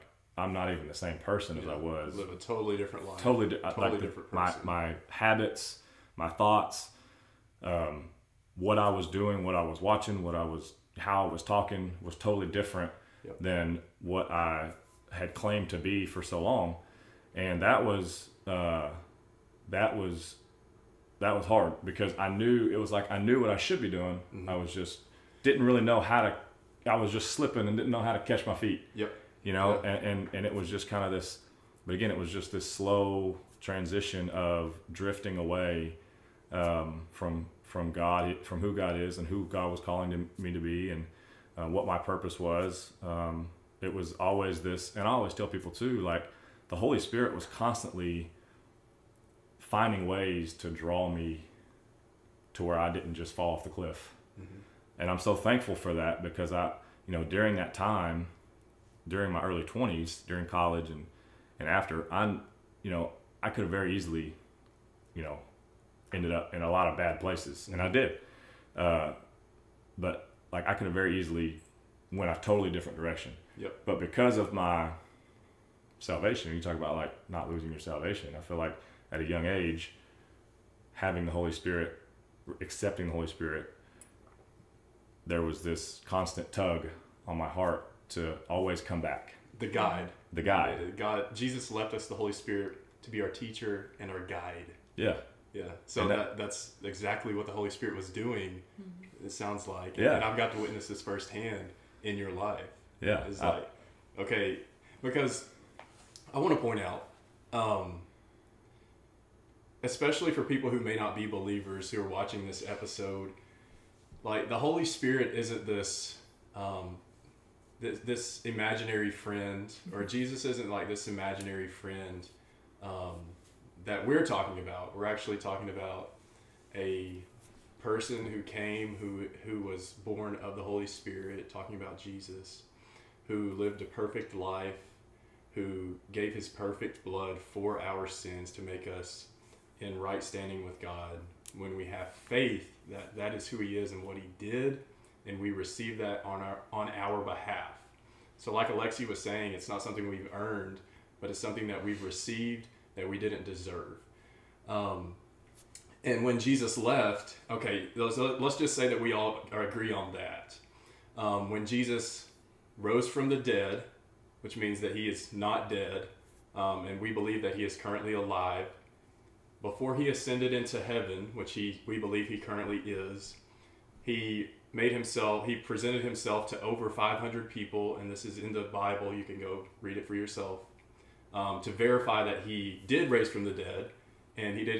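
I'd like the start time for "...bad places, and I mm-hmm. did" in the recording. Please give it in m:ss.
1:06.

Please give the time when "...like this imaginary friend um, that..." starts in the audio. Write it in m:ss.
2:00.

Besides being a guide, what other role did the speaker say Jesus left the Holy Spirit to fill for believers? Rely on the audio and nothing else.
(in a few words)
Teacher.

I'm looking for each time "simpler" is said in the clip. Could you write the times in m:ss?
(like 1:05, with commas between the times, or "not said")
not said.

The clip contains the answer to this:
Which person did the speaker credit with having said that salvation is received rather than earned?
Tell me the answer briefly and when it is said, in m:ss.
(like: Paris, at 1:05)
Alexi, at 2:28.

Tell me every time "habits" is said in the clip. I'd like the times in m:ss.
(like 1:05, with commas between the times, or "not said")
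0:05.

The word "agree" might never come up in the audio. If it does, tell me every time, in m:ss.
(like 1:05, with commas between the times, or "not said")
2:39.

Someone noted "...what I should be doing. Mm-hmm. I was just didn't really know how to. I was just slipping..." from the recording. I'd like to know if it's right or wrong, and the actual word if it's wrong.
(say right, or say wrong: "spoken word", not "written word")
right.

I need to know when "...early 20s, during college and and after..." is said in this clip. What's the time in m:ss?
0:59.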